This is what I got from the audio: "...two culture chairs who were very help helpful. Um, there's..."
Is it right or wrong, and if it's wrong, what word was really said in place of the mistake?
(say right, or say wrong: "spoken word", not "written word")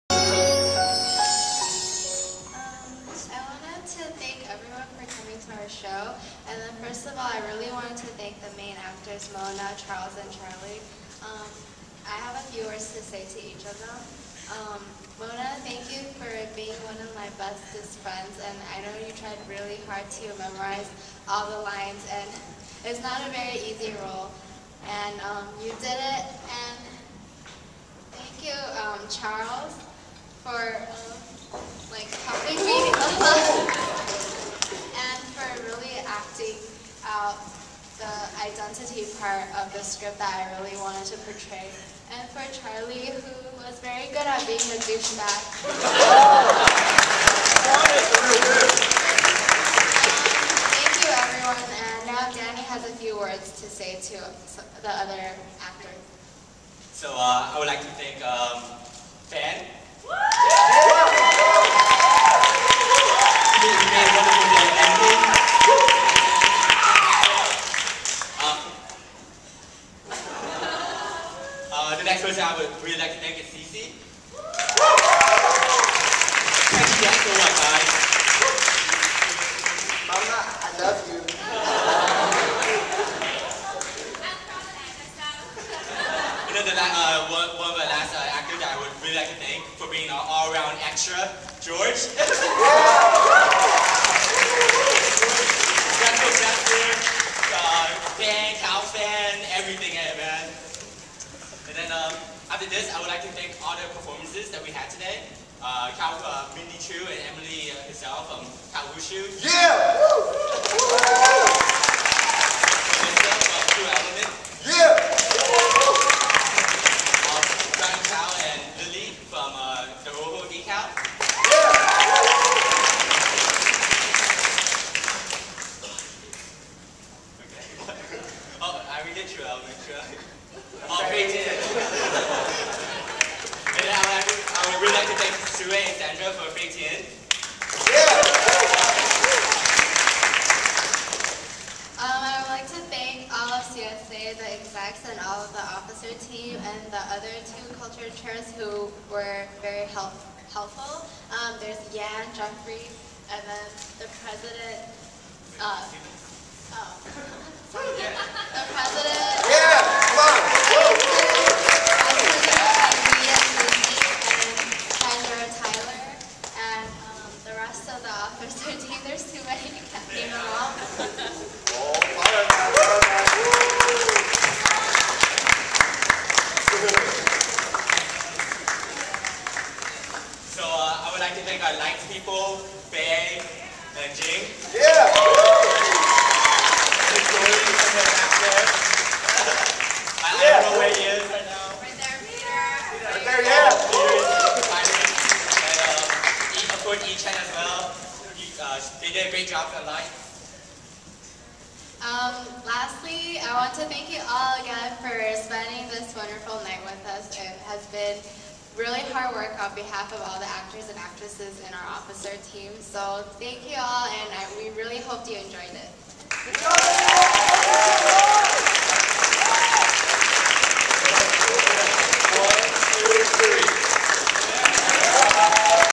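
right.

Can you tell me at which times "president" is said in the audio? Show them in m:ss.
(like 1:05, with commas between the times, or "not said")
2:34.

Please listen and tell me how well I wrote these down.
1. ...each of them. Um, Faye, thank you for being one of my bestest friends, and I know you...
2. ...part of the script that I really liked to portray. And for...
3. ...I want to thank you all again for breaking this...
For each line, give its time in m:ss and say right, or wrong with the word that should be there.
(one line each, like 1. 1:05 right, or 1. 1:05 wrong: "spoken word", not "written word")
1. 0:13 wrong: "Mona", not "Faye"
2. 0:39 wrong: "wanted", not "liked"
3. 3:23 wrong: "spending", not "breaking".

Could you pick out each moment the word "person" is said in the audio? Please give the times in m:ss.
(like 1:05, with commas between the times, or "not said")
1:12.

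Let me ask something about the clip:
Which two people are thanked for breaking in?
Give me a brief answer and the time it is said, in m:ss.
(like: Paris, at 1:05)
Sue and Sandra, at 2:15.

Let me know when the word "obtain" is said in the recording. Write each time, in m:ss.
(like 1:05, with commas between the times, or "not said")
not said.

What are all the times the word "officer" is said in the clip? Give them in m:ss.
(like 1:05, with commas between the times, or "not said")
2:25, 3:31.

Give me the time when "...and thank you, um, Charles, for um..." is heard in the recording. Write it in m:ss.
0:26.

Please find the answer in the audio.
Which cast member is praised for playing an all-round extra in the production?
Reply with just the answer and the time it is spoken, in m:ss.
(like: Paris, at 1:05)
George, at 1:31.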